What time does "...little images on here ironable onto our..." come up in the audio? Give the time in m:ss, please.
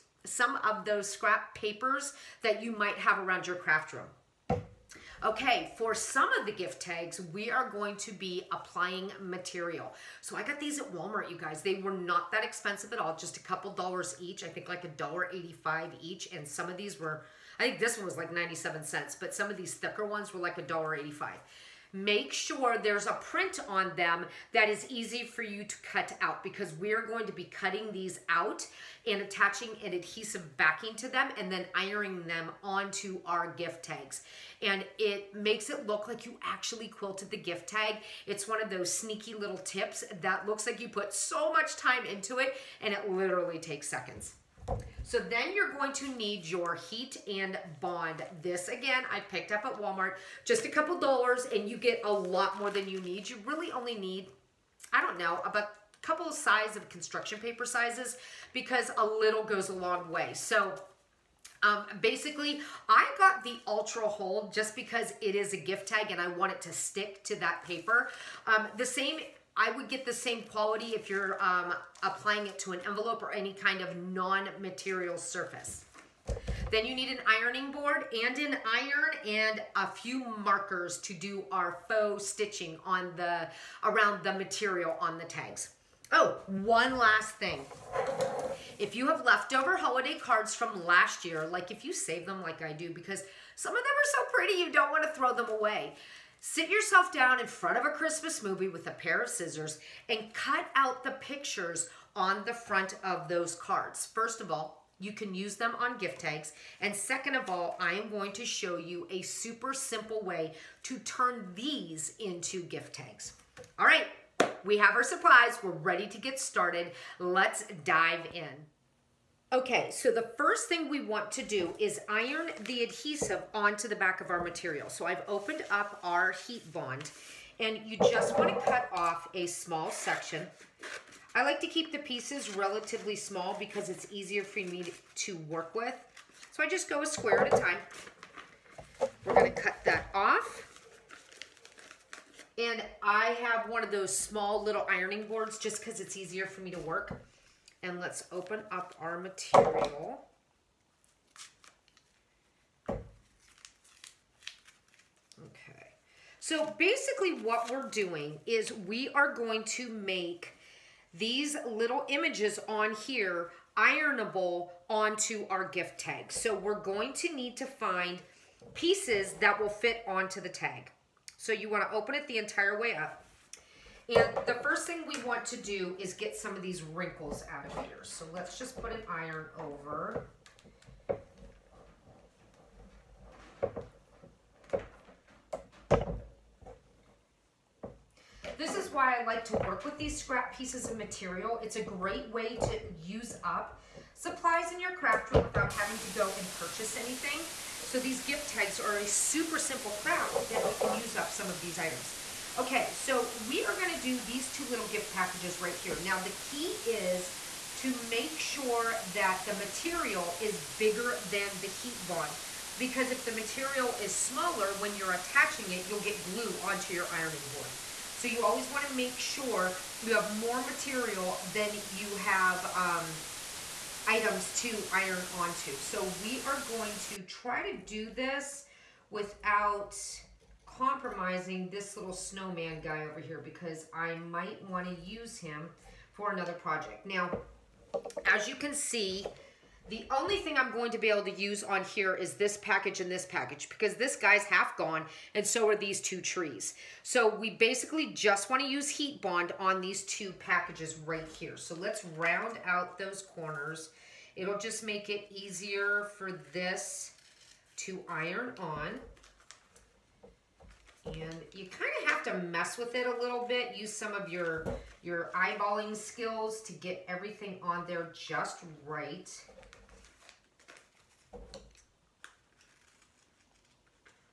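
2:41.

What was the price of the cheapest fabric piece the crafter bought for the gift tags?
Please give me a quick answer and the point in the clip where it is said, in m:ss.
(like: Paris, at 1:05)
97 cents, at 0:18.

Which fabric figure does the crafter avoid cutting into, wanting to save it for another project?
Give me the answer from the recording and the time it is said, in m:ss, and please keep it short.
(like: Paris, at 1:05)
Snowman, at 3:52.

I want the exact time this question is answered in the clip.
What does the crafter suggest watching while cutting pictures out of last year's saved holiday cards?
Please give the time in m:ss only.
1:37.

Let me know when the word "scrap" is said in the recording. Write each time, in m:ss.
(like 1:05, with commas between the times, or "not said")
0:01, 3:10.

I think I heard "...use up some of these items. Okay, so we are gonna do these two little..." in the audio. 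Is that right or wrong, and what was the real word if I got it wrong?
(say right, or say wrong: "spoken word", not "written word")
right.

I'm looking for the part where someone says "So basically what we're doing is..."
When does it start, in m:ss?
2:36.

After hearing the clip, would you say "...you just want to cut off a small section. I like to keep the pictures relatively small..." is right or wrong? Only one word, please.
wrong.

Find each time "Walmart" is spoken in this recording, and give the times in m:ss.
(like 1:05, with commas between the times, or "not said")
0:10, 0:49.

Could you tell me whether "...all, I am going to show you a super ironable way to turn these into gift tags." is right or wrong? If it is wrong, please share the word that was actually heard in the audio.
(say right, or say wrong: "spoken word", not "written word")
wrong: "simple", not "ironable".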